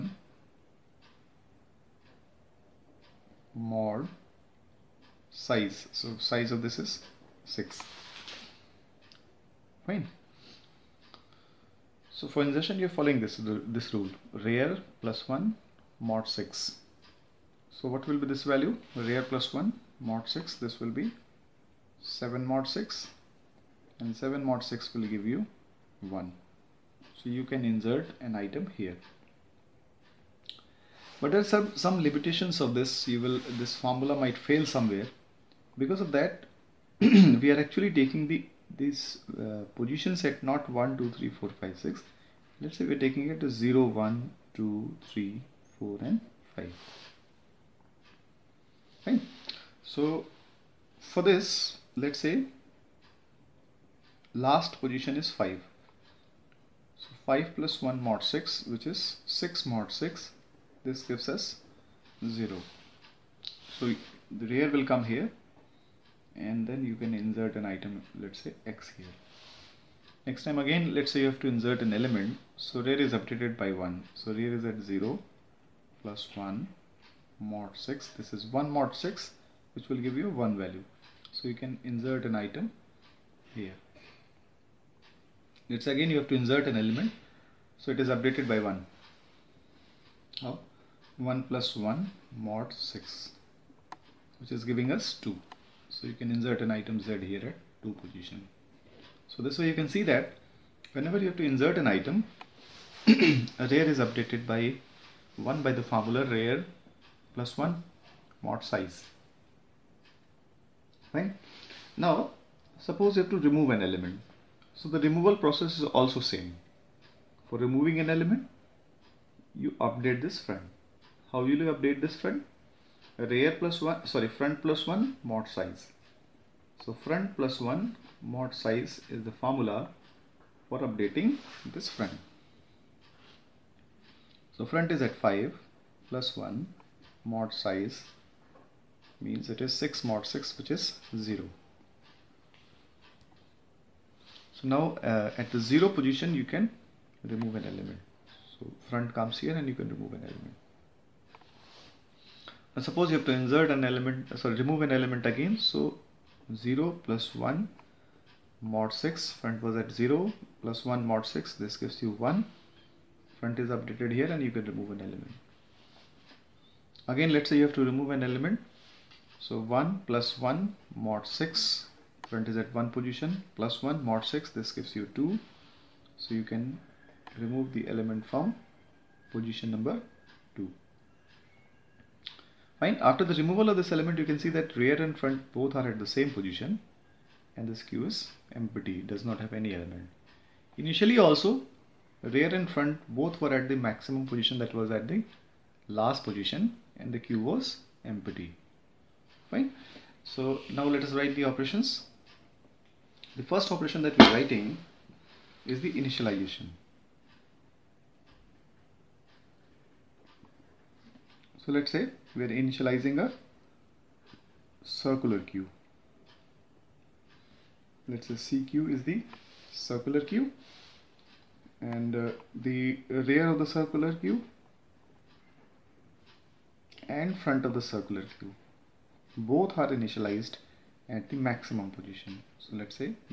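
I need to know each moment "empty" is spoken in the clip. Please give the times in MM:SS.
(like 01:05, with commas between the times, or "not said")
03:08, 03:18.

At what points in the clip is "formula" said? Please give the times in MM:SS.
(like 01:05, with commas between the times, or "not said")
00:33, 01:45, 02:09.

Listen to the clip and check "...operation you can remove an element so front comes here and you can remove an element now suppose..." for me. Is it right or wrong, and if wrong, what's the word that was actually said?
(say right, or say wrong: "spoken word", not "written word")
wrong: "position", not "operation".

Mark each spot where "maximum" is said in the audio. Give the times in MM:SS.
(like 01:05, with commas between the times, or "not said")
03:13, 03:51.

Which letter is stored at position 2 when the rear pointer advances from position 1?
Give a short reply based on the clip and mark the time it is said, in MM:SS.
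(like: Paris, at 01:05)
Z, at 01:36.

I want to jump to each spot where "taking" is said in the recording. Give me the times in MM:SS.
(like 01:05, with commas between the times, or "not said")
00:37, 00:42.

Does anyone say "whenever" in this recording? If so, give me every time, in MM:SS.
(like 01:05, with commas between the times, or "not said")
01:40.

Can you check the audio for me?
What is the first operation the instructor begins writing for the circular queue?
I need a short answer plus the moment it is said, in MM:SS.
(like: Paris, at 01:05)
initialization, at 03:25.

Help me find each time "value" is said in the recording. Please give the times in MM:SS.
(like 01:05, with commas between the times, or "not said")
00:18, 01:20.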